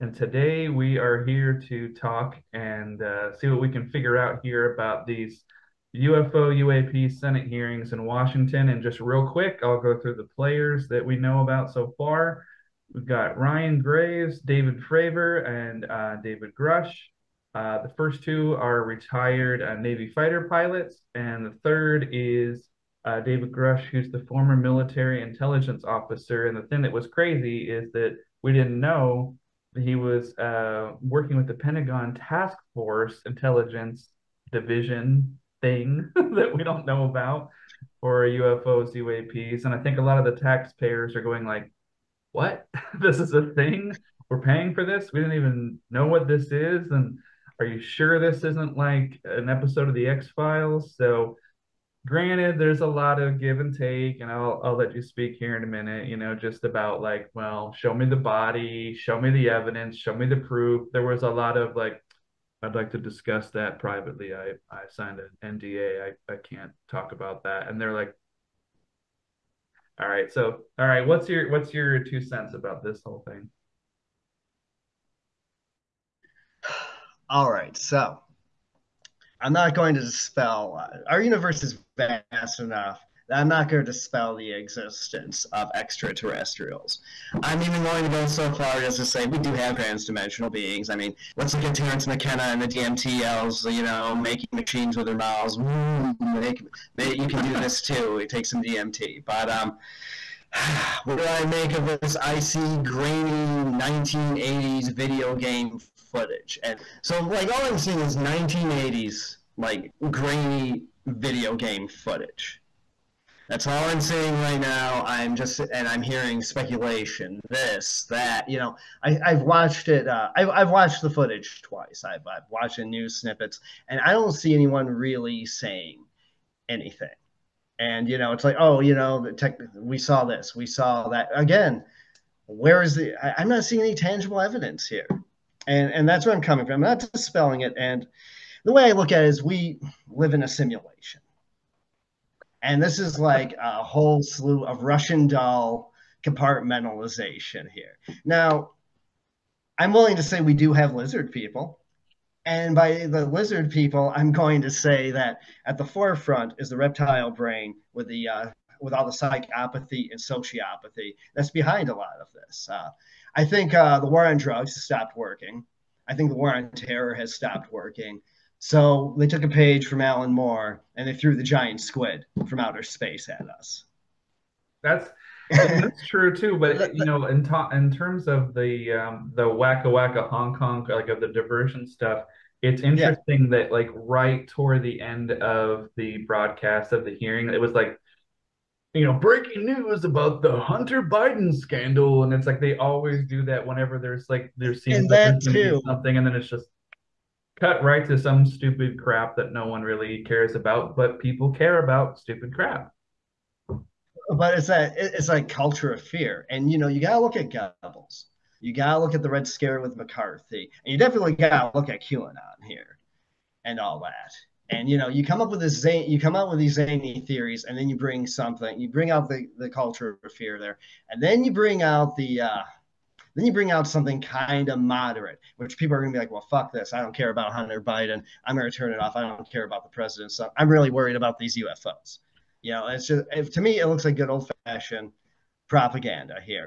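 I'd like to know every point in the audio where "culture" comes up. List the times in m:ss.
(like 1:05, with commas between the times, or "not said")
3:25, 3:39.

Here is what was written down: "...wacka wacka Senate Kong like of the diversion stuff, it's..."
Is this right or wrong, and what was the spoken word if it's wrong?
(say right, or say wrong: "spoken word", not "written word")
wrong: "Hong", not "Senate".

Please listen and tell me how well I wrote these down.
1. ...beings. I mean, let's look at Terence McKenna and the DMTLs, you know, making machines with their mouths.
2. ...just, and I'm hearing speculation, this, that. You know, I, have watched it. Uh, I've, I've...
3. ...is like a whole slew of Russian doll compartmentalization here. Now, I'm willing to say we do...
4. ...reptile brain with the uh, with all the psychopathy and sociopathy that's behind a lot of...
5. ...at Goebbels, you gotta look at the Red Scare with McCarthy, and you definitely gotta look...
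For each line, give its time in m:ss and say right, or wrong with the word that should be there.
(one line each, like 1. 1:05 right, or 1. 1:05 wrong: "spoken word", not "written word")
1. 1:30 right
2. 1:55 right
3. 2:22 right
4. 2:36 right
5. 3:27 right.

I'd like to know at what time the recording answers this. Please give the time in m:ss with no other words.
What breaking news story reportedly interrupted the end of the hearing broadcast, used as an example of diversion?
3:10.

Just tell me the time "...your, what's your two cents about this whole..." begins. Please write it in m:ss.
1:11.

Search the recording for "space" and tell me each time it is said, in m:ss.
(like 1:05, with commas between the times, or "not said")
2:52.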